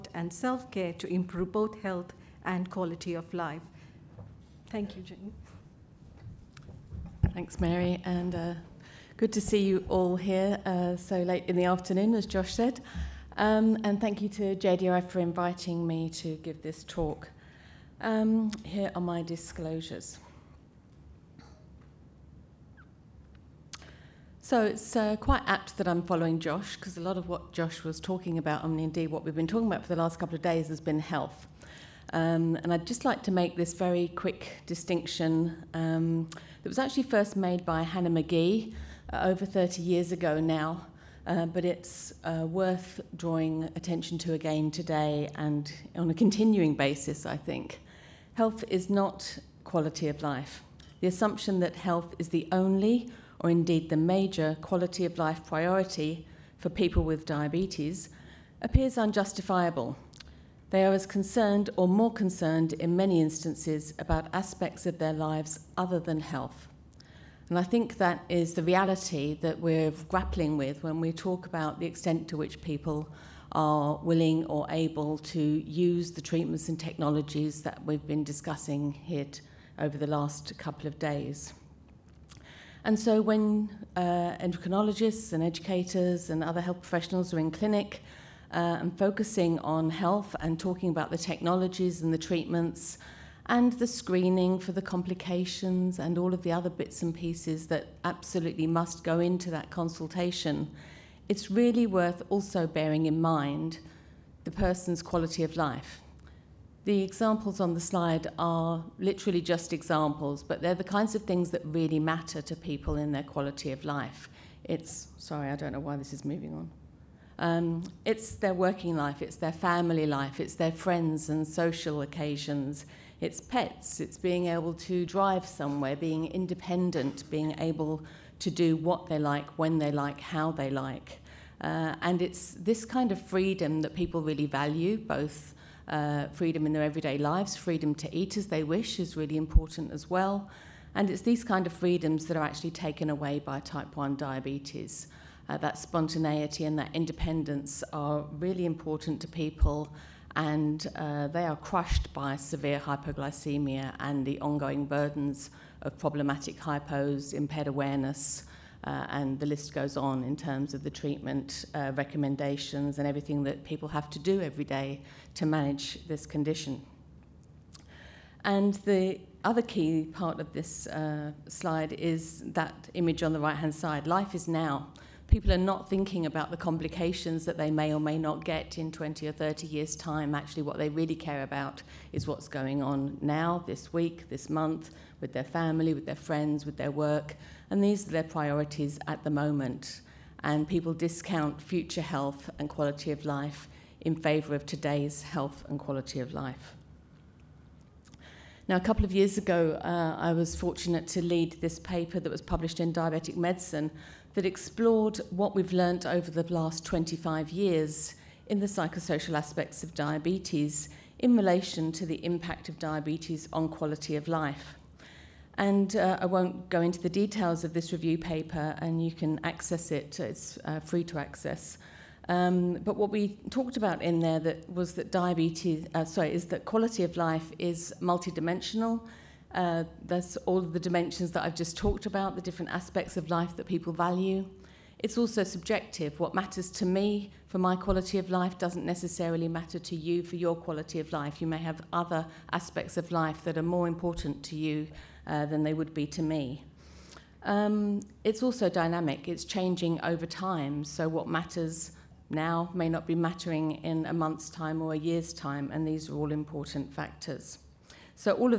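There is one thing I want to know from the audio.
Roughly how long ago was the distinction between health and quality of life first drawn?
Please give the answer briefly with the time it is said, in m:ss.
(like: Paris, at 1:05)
Over 30 years, at 0:39.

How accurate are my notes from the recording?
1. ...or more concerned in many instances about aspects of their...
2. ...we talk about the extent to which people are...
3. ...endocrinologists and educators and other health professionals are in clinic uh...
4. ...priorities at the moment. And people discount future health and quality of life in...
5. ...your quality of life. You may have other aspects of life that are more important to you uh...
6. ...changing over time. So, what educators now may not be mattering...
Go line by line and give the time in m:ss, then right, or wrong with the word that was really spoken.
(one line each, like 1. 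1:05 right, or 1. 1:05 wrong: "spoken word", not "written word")
1. 1:01 right
2. 1:11 right
3. 1:24 right
4. 3:08 right
5. 4:00 right
6. 4:09 wrong: "matters", not "educators".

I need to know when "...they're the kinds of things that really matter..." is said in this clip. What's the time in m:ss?
1:50.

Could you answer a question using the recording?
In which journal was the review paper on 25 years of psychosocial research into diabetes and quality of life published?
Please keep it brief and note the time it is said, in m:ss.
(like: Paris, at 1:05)
Diabetic Medicine, at 3:22.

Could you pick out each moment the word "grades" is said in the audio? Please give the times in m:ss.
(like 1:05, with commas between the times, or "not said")
not said.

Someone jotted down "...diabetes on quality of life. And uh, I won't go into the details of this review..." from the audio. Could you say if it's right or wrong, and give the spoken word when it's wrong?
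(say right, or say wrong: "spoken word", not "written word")
right.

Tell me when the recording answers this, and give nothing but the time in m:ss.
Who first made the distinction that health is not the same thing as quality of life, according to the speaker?
0:37.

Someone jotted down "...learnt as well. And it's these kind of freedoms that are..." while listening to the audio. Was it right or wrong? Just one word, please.
wrong.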